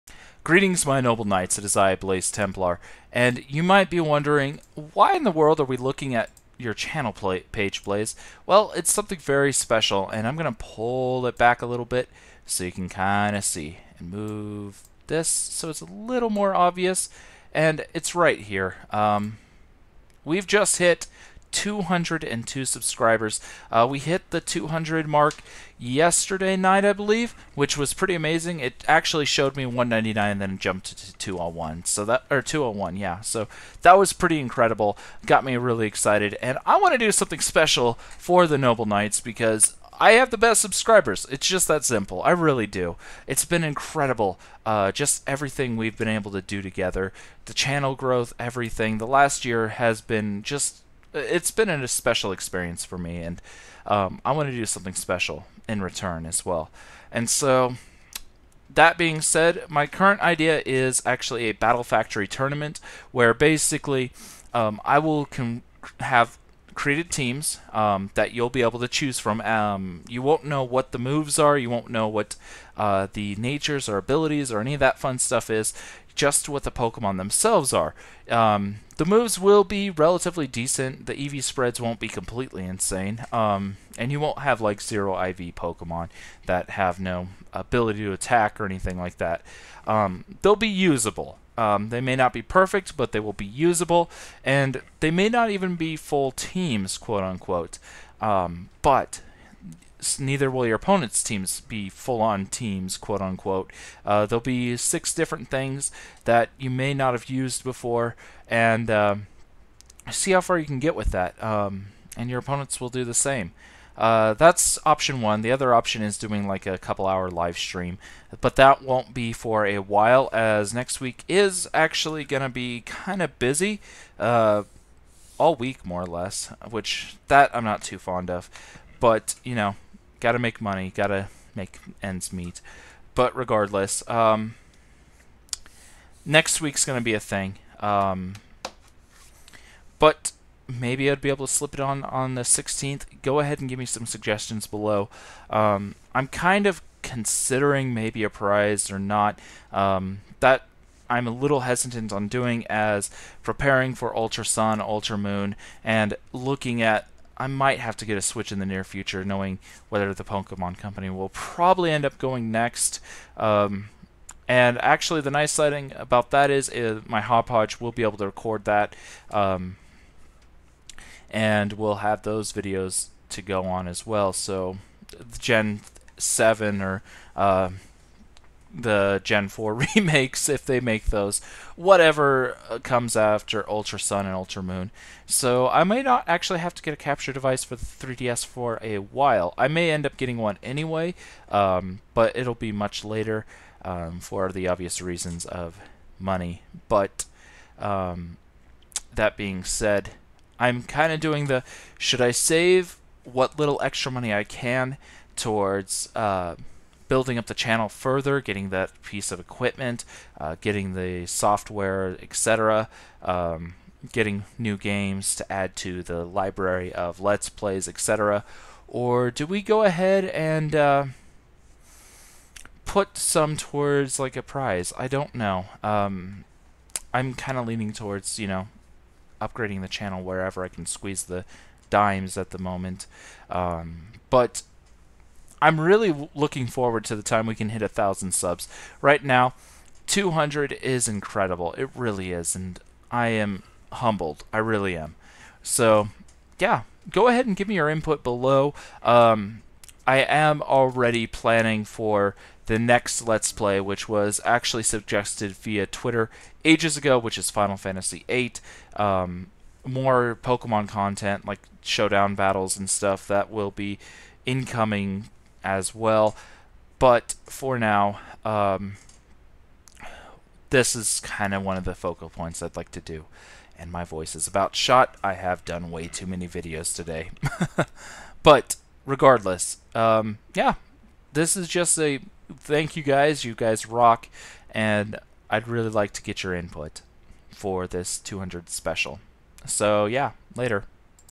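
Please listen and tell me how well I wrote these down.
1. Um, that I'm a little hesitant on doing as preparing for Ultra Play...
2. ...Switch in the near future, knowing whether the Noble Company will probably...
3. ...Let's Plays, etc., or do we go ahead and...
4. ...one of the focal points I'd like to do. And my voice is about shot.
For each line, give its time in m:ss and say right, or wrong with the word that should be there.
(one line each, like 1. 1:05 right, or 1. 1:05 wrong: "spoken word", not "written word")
1. 2:29 wrong: "Sun", not "Play"
2. 2:38 wrong: "Pokemon", not "Noble"
3. 3:37 right
4. 4:31 right.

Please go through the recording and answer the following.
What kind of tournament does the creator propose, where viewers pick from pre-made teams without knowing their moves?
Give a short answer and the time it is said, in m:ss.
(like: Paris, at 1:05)
Battle Factory, at 1:01.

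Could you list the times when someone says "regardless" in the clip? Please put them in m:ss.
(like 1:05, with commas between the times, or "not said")
2:13, 4:39.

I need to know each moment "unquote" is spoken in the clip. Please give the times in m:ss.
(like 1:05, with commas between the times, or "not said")
1:37, 1:43.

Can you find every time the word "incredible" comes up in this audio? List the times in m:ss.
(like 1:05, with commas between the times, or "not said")
0:34, 0:43, 4:01.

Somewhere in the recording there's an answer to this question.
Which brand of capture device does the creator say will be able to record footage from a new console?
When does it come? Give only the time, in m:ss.
2:47.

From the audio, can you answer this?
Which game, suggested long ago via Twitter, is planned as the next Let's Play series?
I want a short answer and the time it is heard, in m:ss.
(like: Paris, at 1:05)
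Final Fantasy VIII, at 4:17.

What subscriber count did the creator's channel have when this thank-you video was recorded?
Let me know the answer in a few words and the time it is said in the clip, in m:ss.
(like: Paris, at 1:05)
202, at 0:21.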